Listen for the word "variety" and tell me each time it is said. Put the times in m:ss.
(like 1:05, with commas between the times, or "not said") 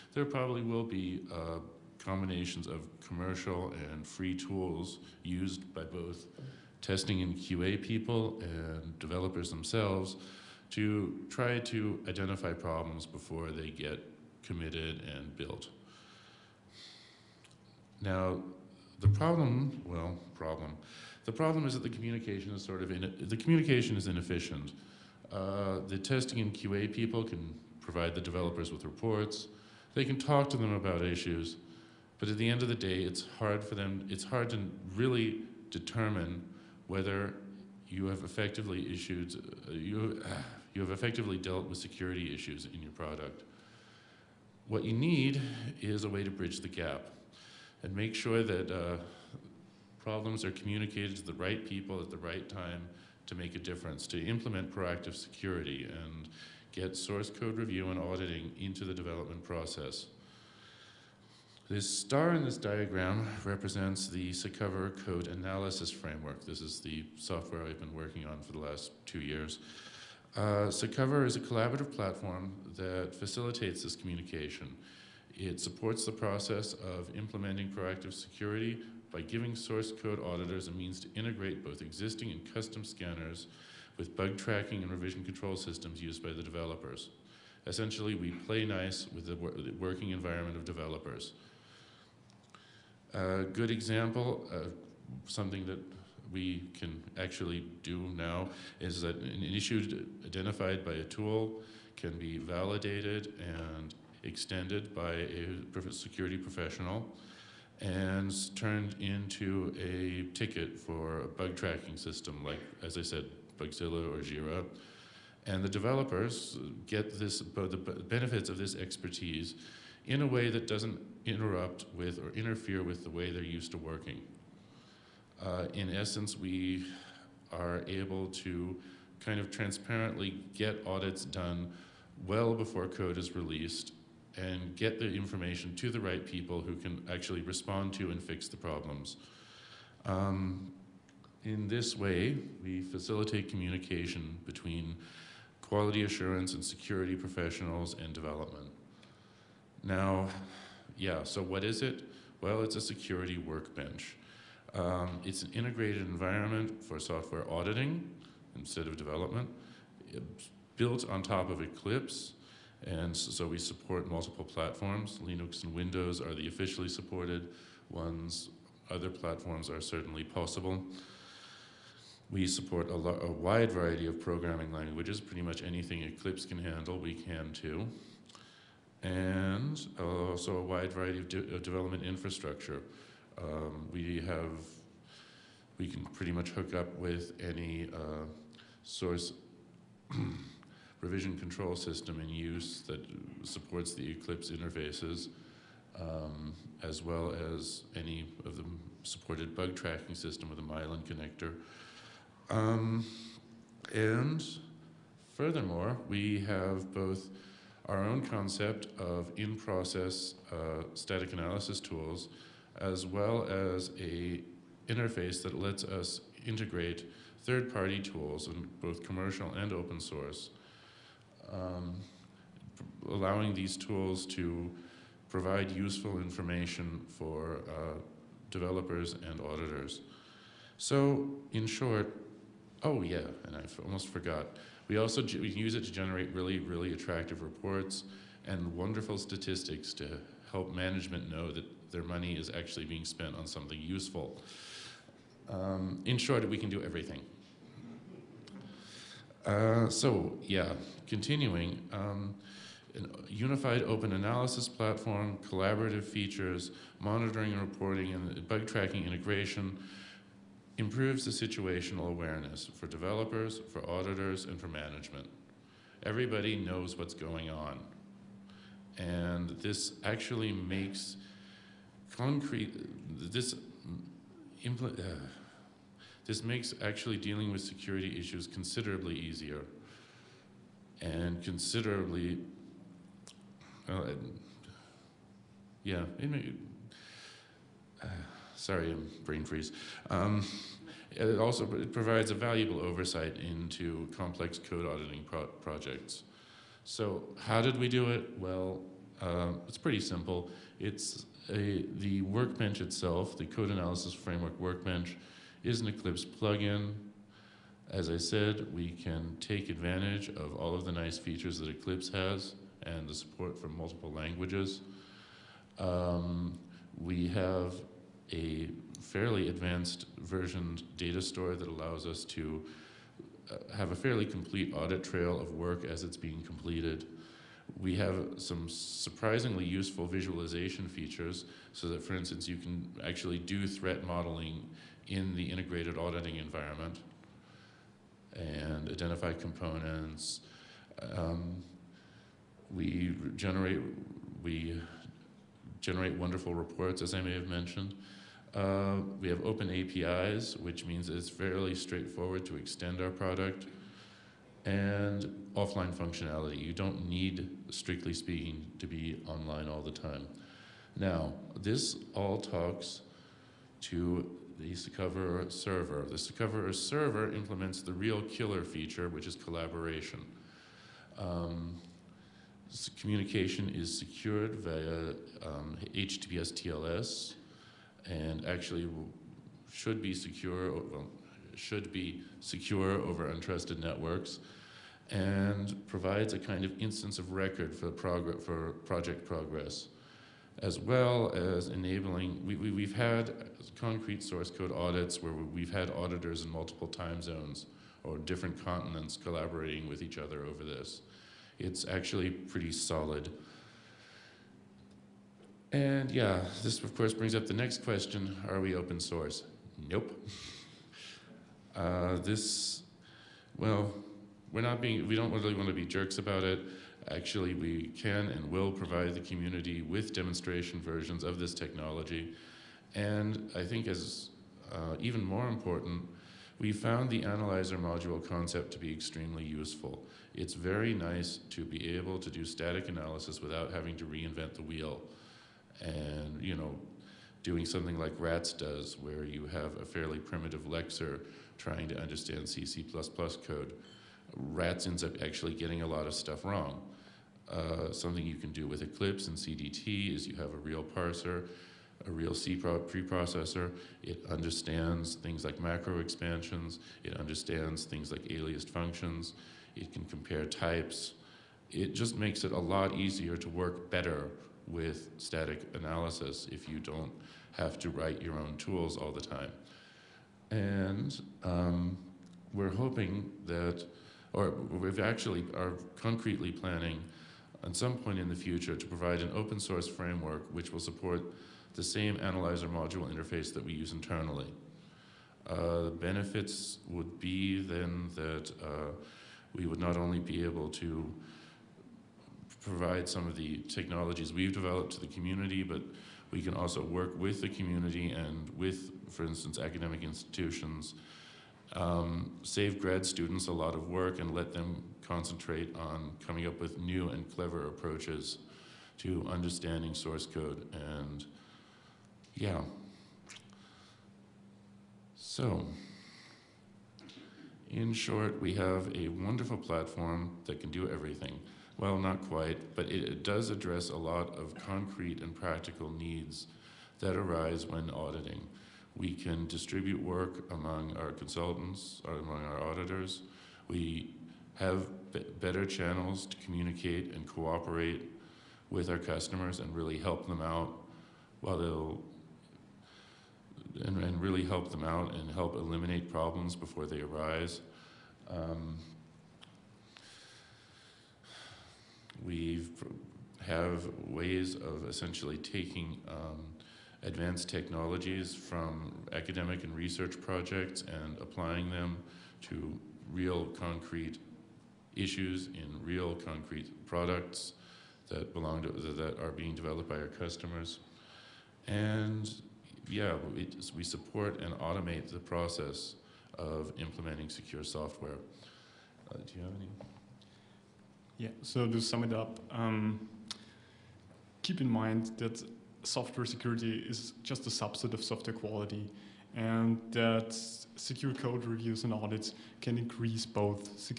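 2:53, 3:00.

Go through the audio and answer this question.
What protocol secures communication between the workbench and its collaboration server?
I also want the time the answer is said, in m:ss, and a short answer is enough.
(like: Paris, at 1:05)
HTTPS TLS, at 6:15.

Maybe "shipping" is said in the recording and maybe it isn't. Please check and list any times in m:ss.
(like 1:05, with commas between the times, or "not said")
not said.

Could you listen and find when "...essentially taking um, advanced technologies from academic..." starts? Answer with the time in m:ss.
9:14.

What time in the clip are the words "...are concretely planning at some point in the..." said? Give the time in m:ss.
7:55.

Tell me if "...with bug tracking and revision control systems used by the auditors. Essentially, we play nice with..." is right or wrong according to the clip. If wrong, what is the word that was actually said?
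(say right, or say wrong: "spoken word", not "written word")
wrong: "developers", not "auditors".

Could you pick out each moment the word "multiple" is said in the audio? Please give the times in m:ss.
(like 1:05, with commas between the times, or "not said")
2:44, 5:13, 6:36.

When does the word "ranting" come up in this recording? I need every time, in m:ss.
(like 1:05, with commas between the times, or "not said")
not said.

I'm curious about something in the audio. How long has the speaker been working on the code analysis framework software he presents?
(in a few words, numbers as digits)
2 years.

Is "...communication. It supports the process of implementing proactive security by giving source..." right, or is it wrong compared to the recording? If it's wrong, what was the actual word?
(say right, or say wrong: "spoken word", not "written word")
right.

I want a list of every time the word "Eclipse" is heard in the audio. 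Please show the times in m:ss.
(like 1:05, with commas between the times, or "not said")
2:41, 2:56, 3:14, 5:05, 5:11, 7:28.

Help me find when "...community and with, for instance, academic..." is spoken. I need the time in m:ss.
8:17.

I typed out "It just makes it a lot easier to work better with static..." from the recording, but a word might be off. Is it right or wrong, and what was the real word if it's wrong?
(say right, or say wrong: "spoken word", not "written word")
right.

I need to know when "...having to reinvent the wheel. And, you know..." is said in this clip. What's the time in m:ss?
7:13.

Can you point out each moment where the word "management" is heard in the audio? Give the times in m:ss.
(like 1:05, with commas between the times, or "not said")
4:00, 4:24.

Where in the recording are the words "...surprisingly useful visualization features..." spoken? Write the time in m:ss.
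5:28.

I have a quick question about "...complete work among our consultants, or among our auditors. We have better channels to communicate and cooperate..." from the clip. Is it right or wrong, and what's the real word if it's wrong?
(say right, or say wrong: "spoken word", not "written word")
wrong: "distribute", not "complete".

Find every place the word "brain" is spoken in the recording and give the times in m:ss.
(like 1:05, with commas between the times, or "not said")
4:49.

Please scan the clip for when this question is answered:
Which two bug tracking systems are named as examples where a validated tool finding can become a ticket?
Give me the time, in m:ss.
1:53.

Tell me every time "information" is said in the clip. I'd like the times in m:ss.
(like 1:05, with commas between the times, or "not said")
2:15, 3:46.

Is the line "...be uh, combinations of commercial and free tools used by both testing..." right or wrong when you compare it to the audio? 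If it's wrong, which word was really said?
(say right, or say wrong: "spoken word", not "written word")
right.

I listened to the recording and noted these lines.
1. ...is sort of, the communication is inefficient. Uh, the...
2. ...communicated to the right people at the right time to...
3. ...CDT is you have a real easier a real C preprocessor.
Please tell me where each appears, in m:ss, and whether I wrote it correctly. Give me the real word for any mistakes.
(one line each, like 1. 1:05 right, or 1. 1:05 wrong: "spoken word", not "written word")
1. 0:22 right
2. 0:50 right
3. 7:29 wrong: "parser", not "easier".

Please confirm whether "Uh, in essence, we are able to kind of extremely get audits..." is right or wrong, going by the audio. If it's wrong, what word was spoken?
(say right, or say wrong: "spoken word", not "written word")
wrong: "transparently", not "extremely".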